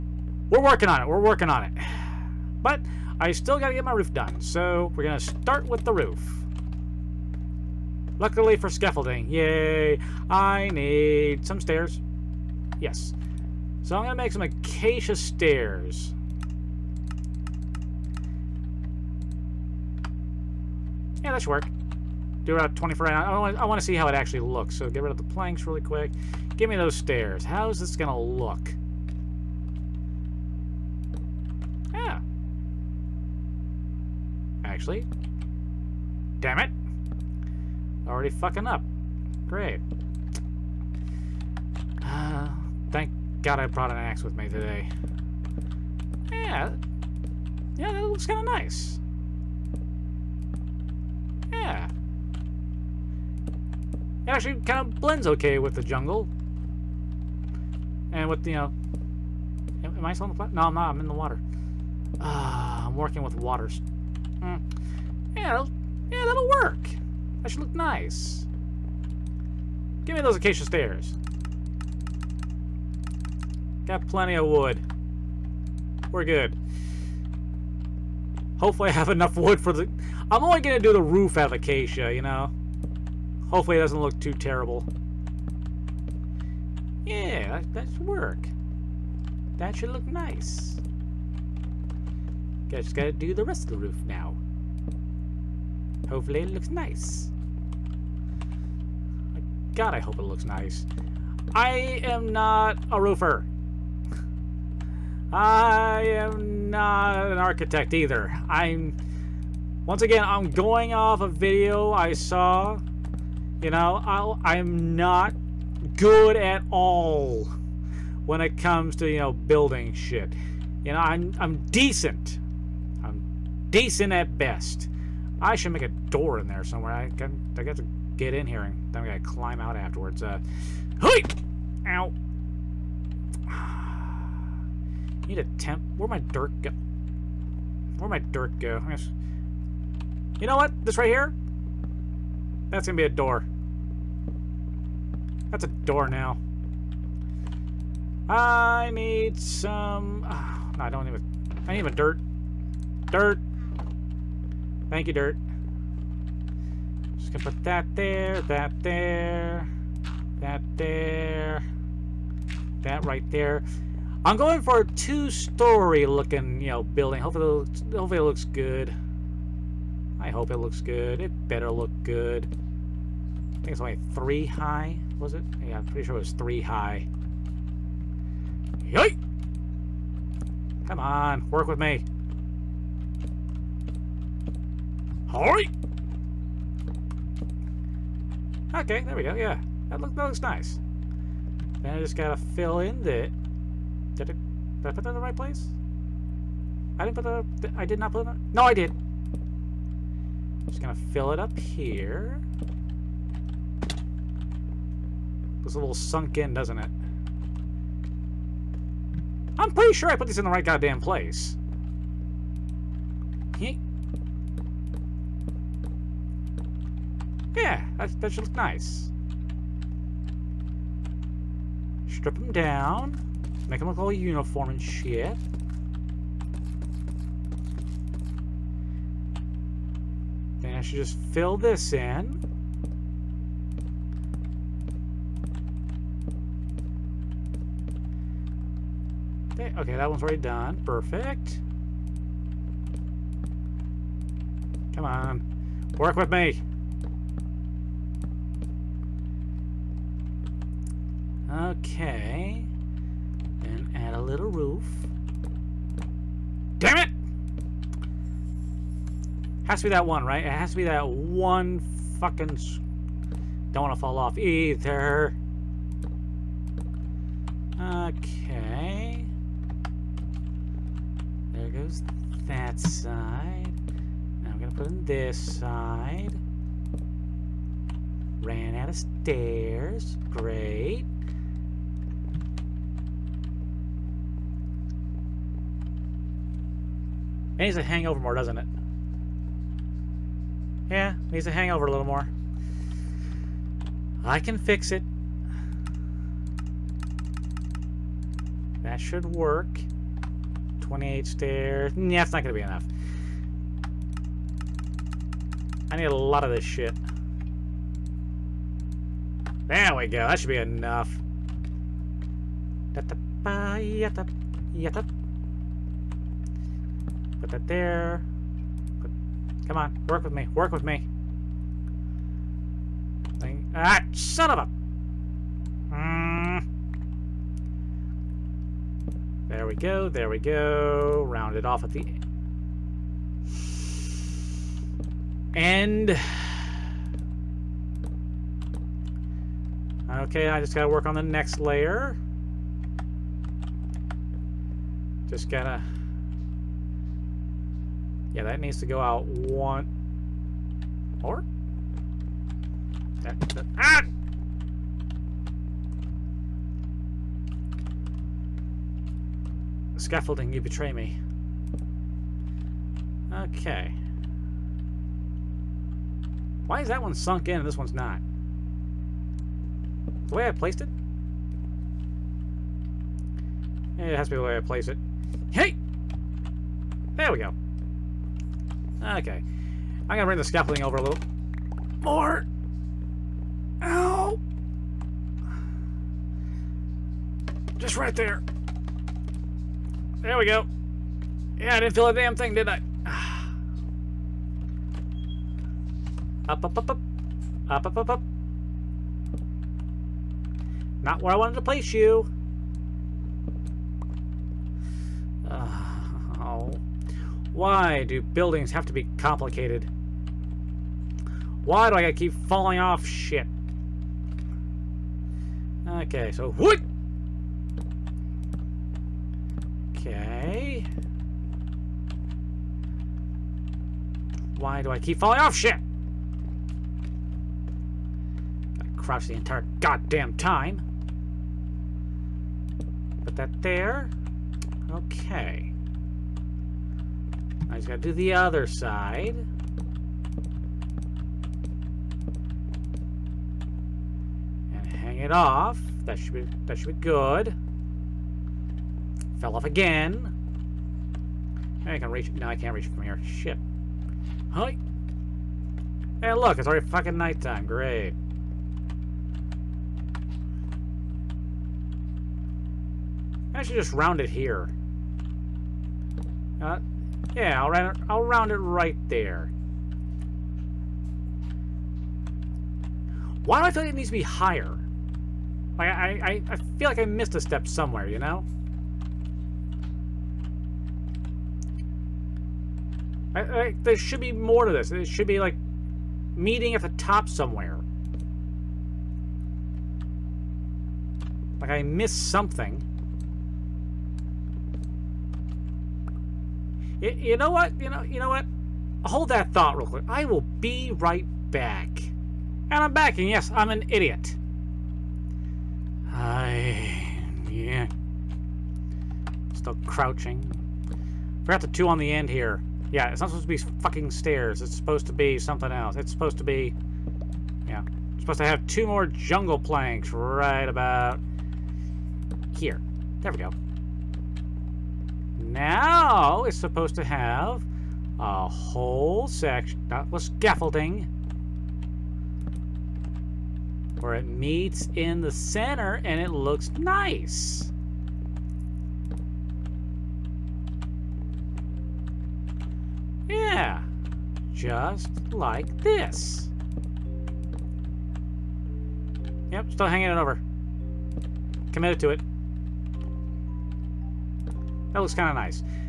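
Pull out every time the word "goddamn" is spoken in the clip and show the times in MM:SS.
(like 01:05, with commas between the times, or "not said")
03:30, 07:09.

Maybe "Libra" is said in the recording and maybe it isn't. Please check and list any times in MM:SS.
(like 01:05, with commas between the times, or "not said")
not said.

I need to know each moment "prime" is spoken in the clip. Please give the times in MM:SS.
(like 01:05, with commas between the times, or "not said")
not said.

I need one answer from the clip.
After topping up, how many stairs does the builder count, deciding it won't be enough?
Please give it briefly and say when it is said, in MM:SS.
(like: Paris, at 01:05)
28, at 05:00.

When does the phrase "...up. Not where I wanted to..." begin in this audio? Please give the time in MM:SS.
06:38.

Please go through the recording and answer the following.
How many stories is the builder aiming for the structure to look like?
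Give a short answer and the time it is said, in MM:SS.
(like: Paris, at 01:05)
2, at 02:44.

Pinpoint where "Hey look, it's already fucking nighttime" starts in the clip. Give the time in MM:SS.
07:36.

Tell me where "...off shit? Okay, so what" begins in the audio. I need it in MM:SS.
06:52.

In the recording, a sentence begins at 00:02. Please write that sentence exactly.
But I still got to get my roof done, so we're going to start with the roof.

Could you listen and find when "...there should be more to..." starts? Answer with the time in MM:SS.
08:03.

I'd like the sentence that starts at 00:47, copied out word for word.
Yeah, that looks kind of nice.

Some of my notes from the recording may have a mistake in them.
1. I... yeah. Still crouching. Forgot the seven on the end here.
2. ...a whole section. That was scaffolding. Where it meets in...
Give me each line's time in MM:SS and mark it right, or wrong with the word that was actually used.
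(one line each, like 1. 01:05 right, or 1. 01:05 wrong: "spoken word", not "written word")
1. 08:26 wrong: "two", not "seven"
2. 08:48 right.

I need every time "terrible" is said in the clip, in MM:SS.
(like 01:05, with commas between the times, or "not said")
01:24.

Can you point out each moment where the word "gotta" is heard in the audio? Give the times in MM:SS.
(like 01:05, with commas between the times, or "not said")
01:32, 02:09, 03:12, 05:40, 05:45, 06:52, 07:08, 07:17.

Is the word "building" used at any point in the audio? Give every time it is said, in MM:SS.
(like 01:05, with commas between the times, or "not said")
01:59, 02:46, 06:48.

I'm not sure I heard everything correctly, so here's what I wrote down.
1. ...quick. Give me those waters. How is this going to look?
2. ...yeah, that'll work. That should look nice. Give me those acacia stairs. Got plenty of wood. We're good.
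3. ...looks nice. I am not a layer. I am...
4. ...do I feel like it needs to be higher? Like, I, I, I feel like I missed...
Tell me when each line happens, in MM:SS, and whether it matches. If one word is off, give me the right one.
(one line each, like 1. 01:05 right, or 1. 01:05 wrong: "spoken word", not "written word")
1. 00:25 wrong: "stairs", not "waters"
2. 01:05 right
3. 01:40 wrong: "roofer", not "layer"
4. 07:53 right.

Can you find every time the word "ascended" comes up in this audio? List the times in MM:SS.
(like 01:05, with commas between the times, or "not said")
not said.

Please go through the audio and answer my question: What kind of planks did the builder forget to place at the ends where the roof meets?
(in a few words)
Jungle planks.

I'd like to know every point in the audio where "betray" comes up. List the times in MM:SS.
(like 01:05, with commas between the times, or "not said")
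06:00.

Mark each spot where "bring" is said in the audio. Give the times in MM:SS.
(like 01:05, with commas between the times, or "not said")
06:20.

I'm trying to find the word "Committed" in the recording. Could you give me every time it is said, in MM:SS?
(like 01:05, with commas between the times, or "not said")
09:11.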